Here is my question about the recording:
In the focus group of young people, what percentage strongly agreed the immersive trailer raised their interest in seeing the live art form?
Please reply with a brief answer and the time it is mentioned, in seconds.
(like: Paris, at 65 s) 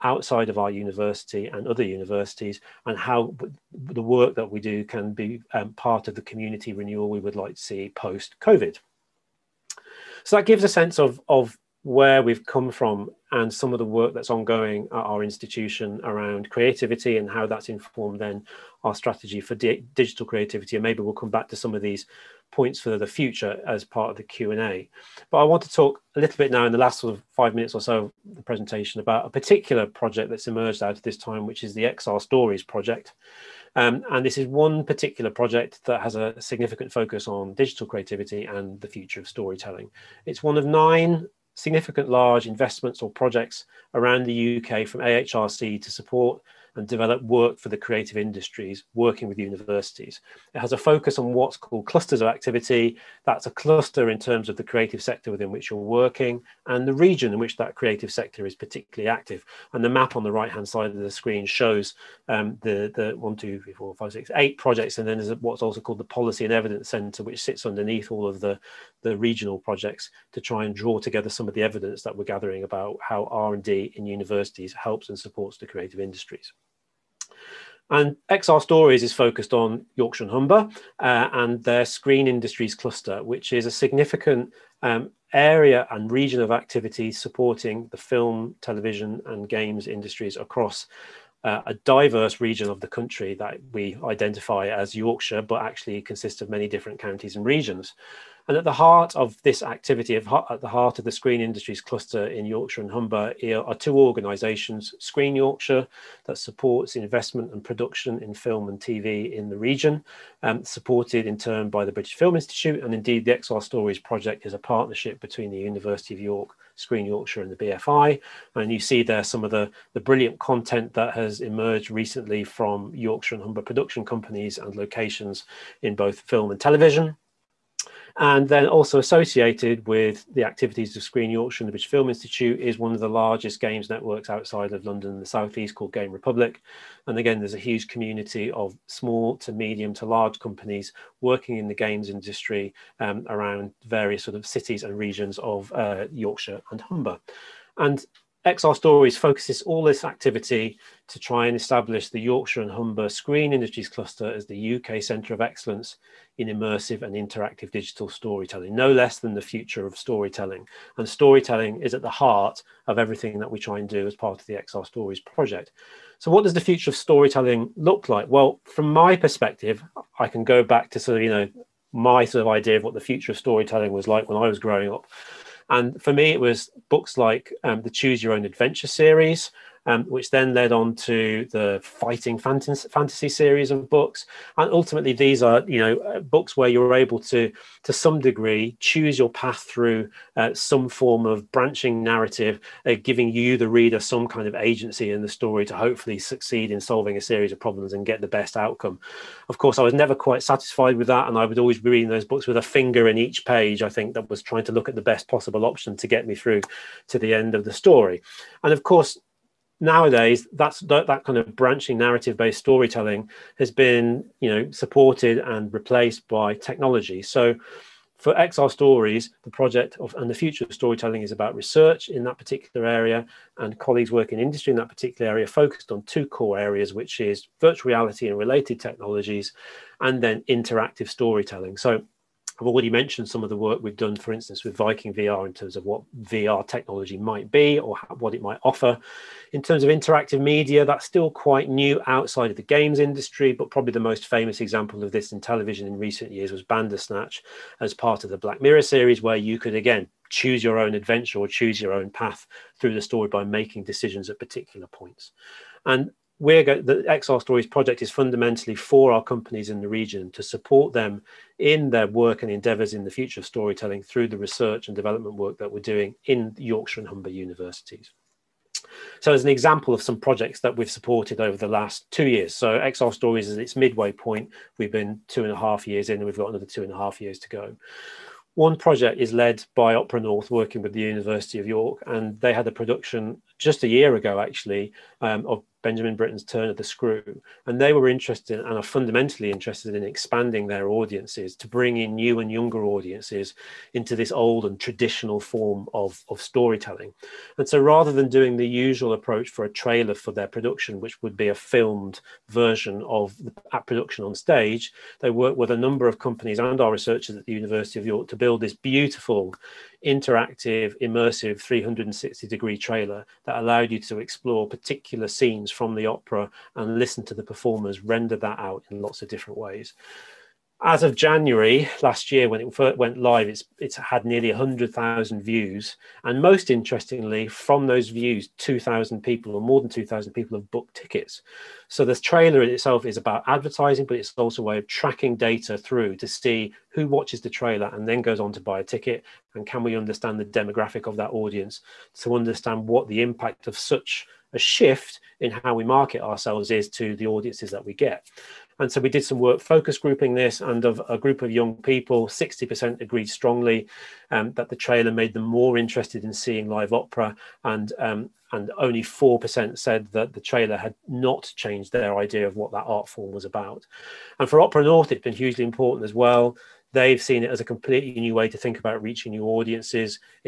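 60%, at 352 s.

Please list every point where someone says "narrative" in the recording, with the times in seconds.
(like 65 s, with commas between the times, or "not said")
192 s, 211 s.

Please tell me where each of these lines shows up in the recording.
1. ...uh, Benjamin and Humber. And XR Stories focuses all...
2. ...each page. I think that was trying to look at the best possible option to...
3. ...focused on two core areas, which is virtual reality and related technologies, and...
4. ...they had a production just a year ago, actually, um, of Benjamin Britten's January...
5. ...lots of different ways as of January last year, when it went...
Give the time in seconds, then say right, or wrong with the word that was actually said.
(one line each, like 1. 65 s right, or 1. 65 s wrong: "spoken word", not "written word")
1. 145 s wrong: "Yorkshire", not "Benjamin"
2. 203 s right
3. 225 s right
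4. 282 s wrong: "Turn", not "January"
5. 319 s right.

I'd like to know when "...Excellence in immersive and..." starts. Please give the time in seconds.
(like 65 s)
155 s.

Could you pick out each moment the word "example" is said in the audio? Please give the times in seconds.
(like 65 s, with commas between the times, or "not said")
244 s, 269 s.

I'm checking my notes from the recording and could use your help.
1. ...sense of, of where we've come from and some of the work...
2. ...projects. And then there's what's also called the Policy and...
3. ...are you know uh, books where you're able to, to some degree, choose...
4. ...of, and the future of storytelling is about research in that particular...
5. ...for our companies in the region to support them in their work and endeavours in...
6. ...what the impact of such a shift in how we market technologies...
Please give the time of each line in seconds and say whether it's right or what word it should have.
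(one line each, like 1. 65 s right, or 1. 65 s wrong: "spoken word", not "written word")
1. 10 s right
2. 64 s right
3. 185 s right
4. 219 s right
5. 258 s right
6. 342 s wrong: "ourselves", not "technologies".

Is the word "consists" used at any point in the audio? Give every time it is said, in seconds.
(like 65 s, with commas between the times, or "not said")
96 s.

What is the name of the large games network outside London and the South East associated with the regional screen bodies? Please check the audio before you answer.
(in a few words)
Game Republic.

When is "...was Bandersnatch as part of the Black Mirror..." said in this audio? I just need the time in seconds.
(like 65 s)
246 s.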